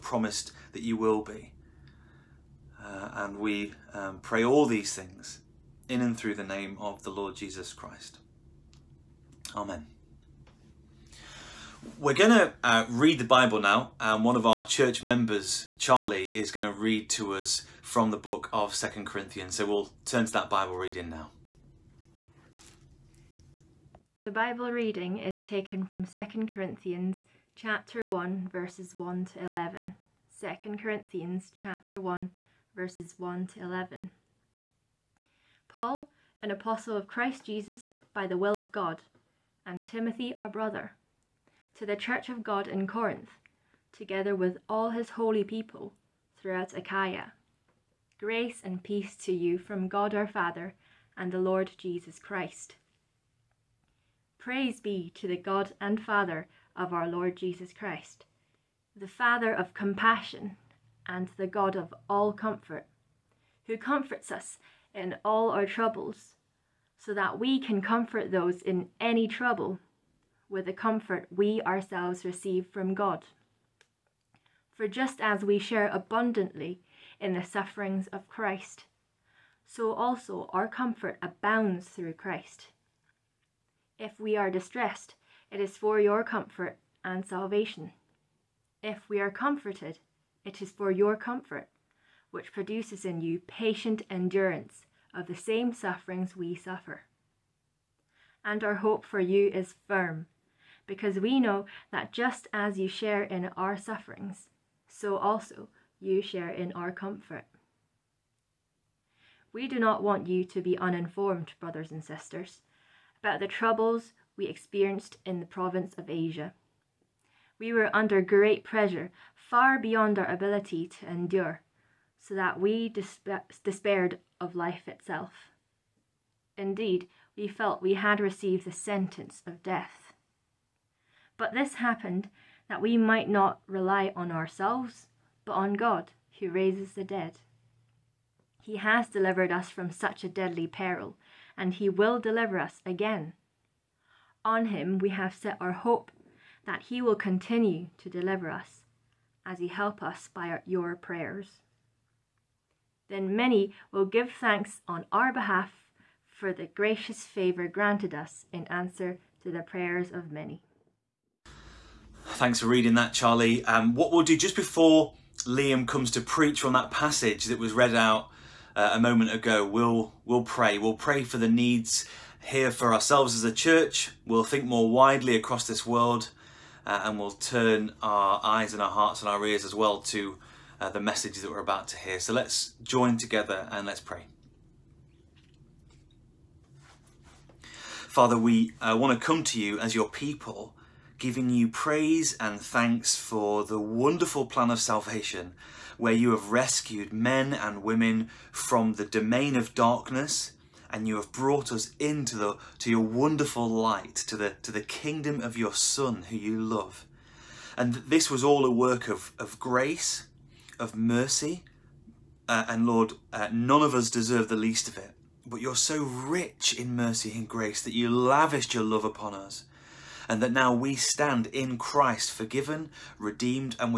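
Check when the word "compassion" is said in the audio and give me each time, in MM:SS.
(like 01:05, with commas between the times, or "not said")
00:59.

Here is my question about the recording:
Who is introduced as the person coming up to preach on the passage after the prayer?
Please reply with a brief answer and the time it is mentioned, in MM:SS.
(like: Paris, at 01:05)
Liam, at 02:45.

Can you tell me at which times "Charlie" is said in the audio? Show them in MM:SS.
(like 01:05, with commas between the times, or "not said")
00:15, 02:43.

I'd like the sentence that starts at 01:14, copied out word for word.
For just as we share abundantly in the sufferings of Christ, so also our comfort abounds through Christ.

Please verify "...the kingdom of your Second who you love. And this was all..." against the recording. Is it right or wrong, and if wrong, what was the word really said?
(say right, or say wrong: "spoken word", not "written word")
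wrong: "Son", not "Second".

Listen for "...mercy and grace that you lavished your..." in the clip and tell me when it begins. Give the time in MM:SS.
03:36.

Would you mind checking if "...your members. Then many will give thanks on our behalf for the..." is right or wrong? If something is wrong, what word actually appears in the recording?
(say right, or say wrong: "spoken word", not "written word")
wrong: "prayers", not "members".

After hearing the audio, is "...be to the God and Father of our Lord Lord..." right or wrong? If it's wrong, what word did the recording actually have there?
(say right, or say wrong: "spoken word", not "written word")
wrong: "Jesus", not "Lord".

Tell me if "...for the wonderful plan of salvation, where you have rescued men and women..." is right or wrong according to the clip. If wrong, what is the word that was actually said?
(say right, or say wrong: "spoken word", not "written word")
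right.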